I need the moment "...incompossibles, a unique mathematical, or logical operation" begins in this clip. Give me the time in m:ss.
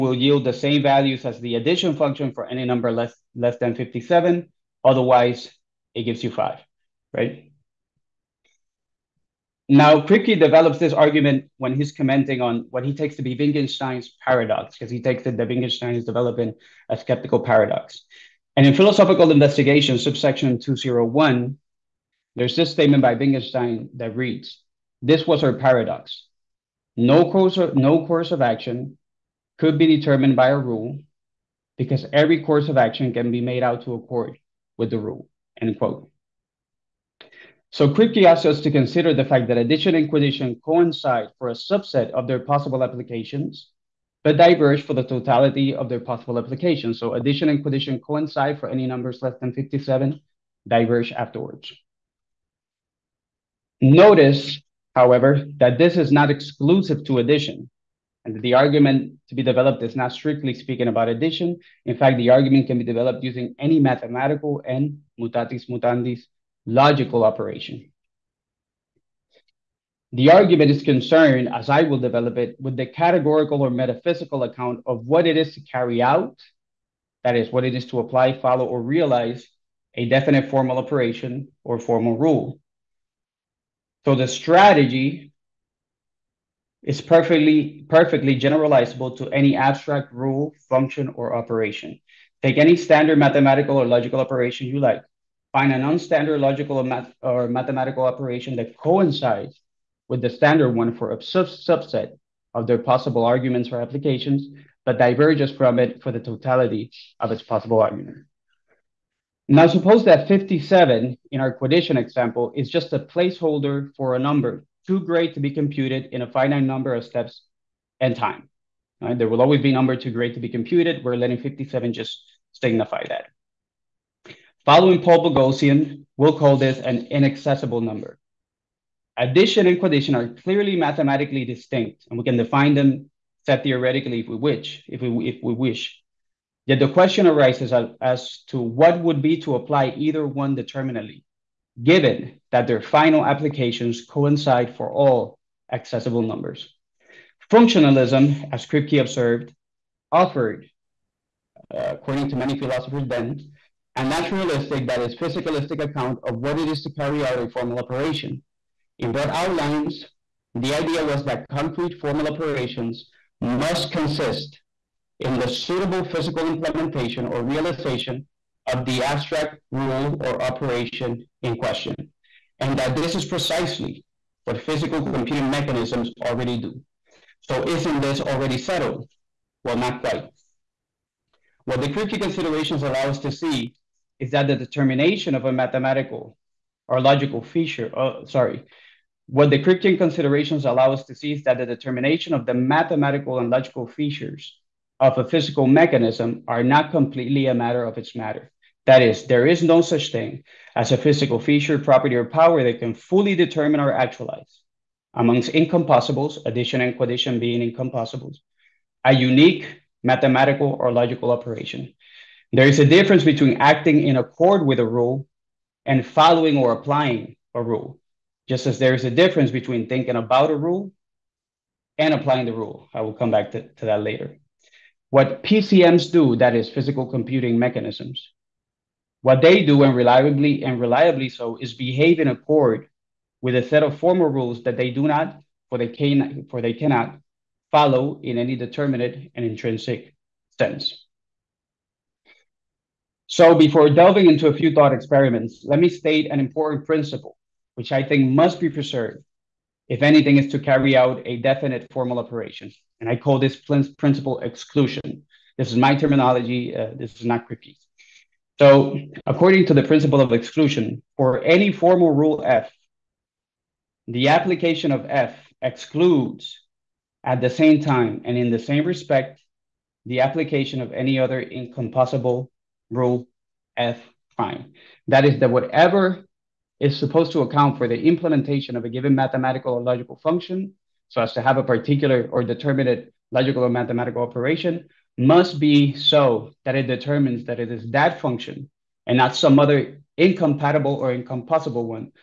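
3:27.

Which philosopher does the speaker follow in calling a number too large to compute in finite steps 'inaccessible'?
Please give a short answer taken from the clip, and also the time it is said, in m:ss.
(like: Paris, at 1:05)
Paul Boghossian, at 2:05.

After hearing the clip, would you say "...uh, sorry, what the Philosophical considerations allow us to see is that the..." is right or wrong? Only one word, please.
wrong.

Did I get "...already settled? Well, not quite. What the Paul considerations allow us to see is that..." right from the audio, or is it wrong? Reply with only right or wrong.
wrong.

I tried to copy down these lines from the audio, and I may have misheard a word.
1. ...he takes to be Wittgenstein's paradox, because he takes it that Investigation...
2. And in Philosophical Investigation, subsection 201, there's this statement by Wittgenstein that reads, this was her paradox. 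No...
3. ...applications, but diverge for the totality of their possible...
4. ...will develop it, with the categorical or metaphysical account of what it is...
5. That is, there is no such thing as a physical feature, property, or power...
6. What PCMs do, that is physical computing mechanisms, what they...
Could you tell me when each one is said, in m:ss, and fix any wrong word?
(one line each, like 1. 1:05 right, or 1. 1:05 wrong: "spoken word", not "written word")
1. 0:12 wrong: "Wittgenstein", not "Investigation"
2. 0:18 right
3. 0:42 right
4. 1:11 right
5. 3:18 right
6. 3:45 right.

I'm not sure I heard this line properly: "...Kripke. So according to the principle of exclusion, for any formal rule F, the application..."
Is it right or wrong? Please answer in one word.
right.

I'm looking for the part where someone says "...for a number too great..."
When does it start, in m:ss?
1:53.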